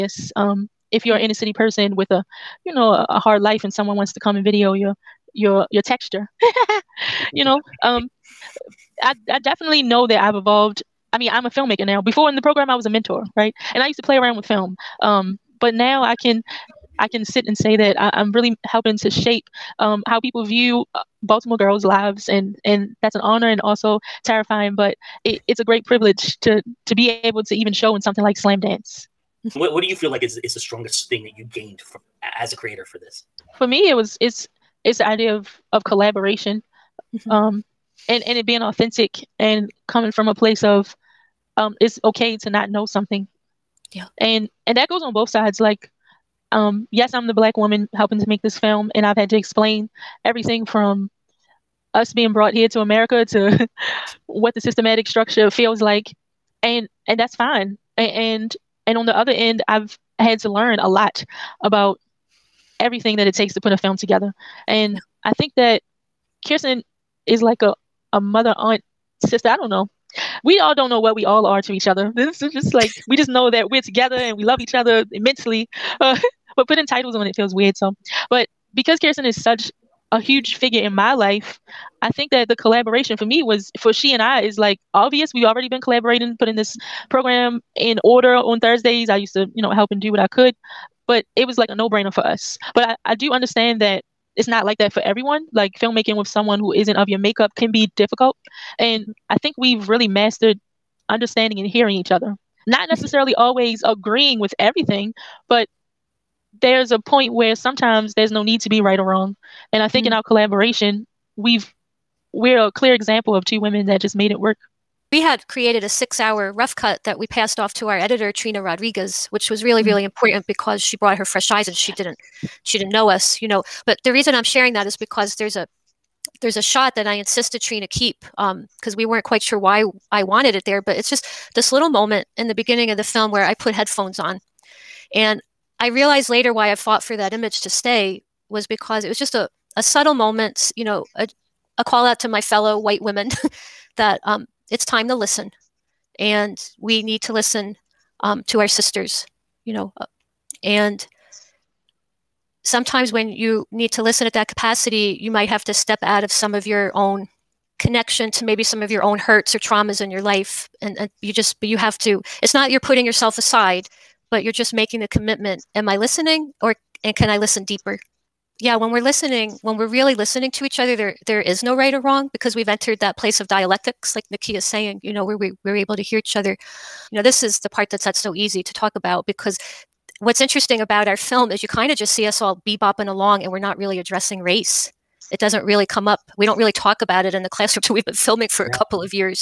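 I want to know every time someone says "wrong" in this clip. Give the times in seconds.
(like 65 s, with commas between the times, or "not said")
109 s, 172 s.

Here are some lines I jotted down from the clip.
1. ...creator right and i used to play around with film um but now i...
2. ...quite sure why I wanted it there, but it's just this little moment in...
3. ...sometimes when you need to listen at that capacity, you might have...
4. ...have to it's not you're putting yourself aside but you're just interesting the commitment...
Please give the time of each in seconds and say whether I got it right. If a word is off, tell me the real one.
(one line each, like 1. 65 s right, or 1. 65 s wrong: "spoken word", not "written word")
1. 12 s wrong: "mentor", not "creator"
2. 129 s right
3. 152 s right
4. 161 s wrong: "making", not "interesting".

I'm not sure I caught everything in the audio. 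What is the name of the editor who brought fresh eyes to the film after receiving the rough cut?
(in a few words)
Trina Rodriguez.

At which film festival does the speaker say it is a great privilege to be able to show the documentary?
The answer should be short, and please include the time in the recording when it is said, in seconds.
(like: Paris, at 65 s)
Slamdance, at 28 s.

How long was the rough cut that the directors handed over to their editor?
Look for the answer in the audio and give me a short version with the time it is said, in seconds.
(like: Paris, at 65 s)
6 hours, at 115 s.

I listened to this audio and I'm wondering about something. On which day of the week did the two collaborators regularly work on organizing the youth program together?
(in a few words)
Thursdays.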